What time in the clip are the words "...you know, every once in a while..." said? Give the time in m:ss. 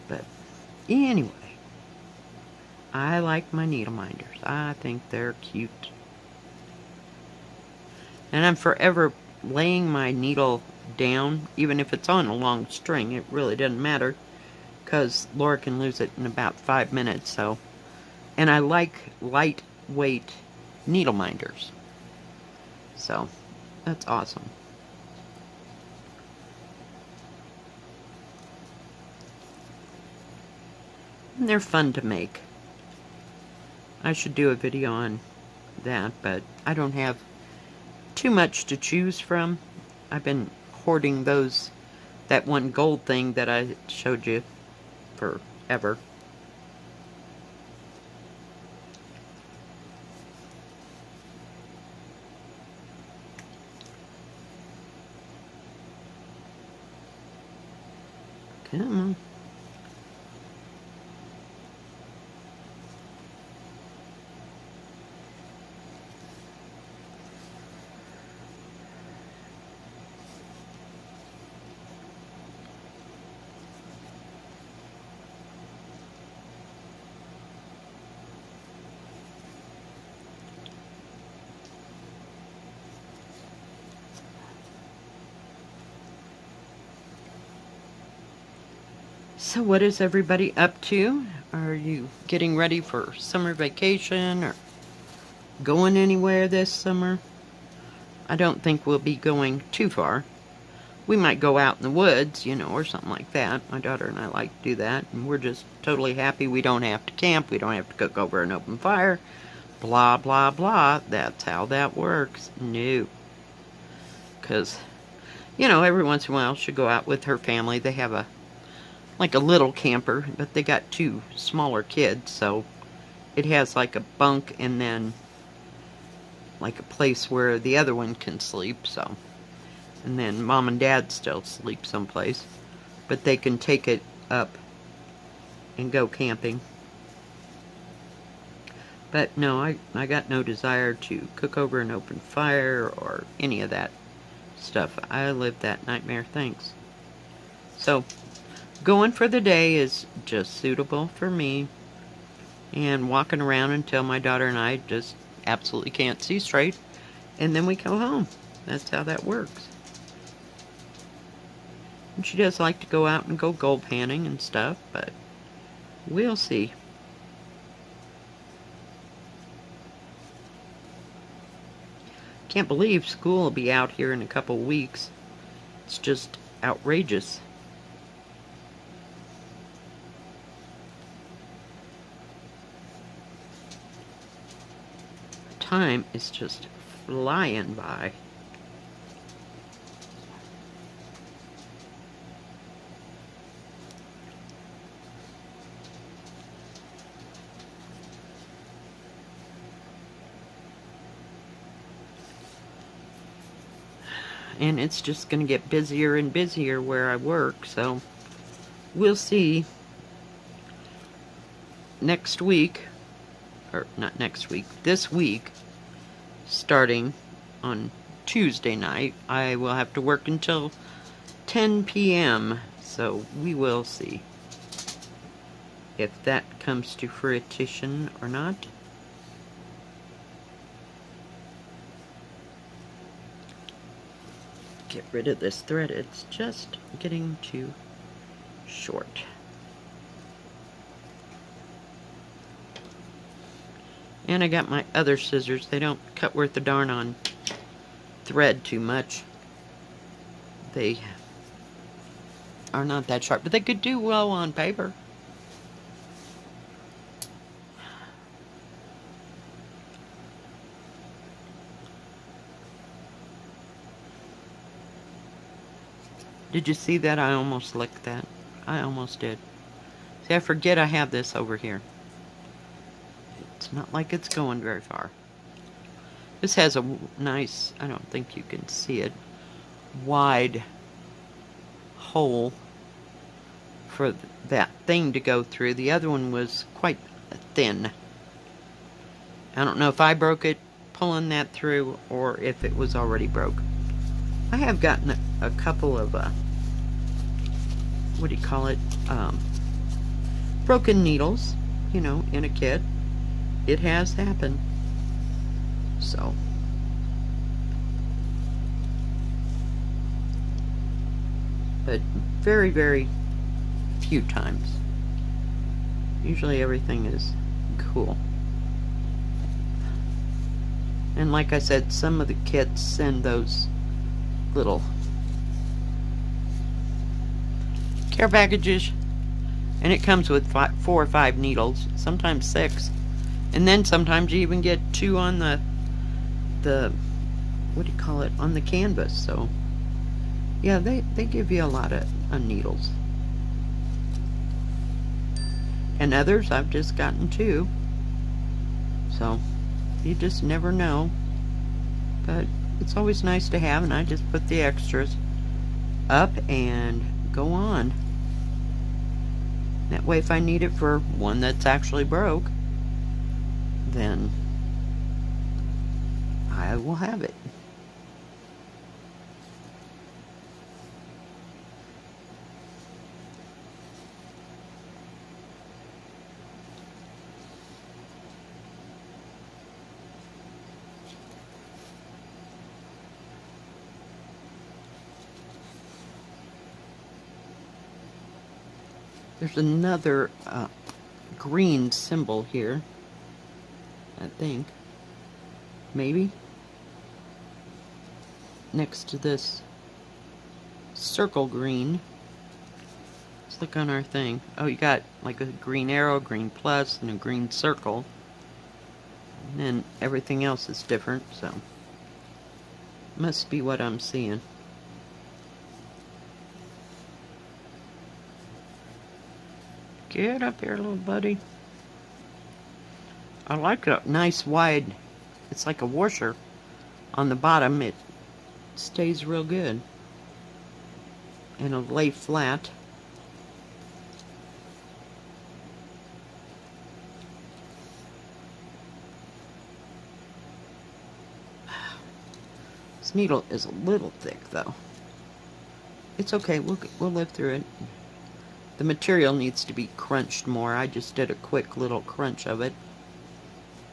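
1:55.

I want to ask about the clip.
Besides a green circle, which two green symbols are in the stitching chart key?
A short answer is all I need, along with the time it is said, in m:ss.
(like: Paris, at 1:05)
Green arrow, green plus, at 6:45.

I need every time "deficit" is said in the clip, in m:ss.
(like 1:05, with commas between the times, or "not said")
not said.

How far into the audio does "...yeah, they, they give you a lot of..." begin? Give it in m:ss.
5:40.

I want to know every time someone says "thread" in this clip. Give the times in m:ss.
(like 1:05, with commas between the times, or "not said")
3:55, 4:08.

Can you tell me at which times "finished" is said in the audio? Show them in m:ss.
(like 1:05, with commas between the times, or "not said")
not said.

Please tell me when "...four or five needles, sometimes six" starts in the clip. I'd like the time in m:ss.
5:30.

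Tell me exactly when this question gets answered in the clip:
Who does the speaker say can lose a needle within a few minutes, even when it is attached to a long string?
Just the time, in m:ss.
0:15.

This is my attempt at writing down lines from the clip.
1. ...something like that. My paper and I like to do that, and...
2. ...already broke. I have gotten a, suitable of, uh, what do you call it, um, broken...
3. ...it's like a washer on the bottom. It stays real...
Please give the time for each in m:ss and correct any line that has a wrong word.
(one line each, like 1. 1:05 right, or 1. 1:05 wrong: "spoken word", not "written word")
1. 1:42 wrong: "daughter", not "paper"
2. 4:52 wrong: "couple", not "suitable"
3. 7:05 right.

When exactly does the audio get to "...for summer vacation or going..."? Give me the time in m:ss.
1:32.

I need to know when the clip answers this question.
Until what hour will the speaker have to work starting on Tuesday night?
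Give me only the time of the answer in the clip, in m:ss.
3:41.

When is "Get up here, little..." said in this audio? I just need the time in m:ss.
7:00.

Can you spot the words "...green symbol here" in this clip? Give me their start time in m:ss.
6:31.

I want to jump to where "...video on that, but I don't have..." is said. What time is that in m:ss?
0:34.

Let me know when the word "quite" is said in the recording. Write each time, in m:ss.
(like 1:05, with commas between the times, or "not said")
4:46.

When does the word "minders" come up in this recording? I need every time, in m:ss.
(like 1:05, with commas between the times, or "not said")
0:03, 0:21.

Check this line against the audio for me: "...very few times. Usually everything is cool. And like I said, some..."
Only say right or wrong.
right.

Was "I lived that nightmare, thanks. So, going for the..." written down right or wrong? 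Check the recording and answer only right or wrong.
right.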